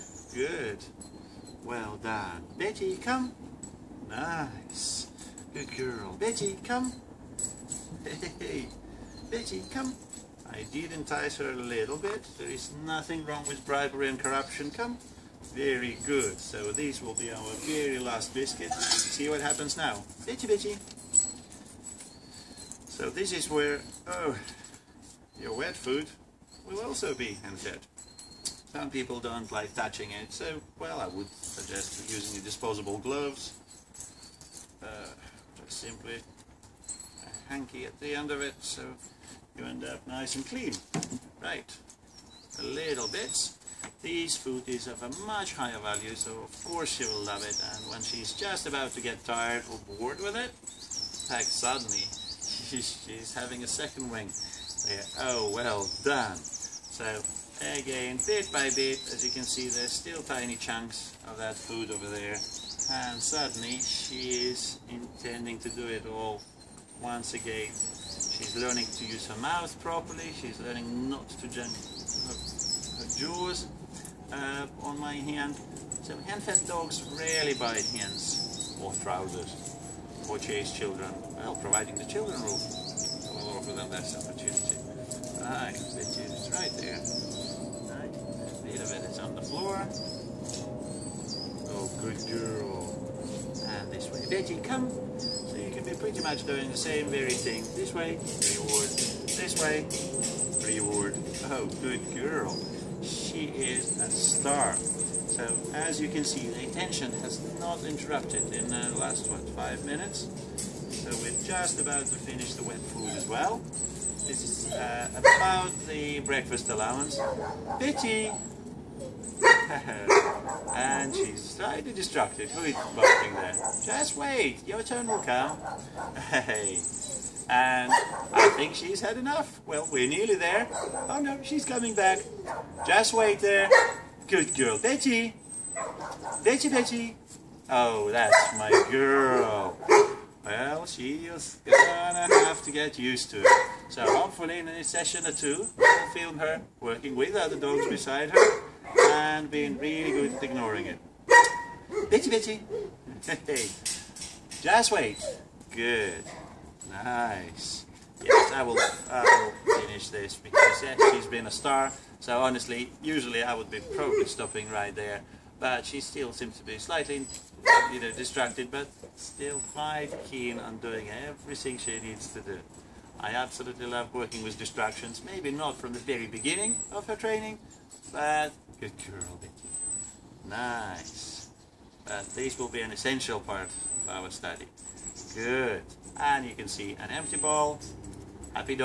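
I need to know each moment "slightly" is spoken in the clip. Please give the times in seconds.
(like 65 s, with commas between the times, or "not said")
121 s, 166 s.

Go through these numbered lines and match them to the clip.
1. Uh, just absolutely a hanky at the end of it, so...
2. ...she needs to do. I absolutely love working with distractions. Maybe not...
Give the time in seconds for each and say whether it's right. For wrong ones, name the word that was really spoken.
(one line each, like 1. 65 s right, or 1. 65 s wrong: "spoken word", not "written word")
1. 34 s wrong: "simply", not "absolutely"
2. 171 s right.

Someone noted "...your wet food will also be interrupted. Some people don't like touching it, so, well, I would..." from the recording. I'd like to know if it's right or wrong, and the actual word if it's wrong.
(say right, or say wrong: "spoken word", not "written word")
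wrong: "unfed", not "interrupted".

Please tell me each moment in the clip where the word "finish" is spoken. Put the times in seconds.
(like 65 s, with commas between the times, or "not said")
112 s, 159 s.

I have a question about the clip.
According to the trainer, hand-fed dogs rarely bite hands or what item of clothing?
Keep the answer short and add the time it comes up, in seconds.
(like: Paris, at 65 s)
Trousers, at 79 s.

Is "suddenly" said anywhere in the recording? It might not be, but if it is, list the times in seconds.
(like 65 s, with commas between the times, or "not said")
51 s, 63 s.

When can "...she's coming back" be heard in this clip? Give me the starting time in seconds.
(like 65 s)
131 s.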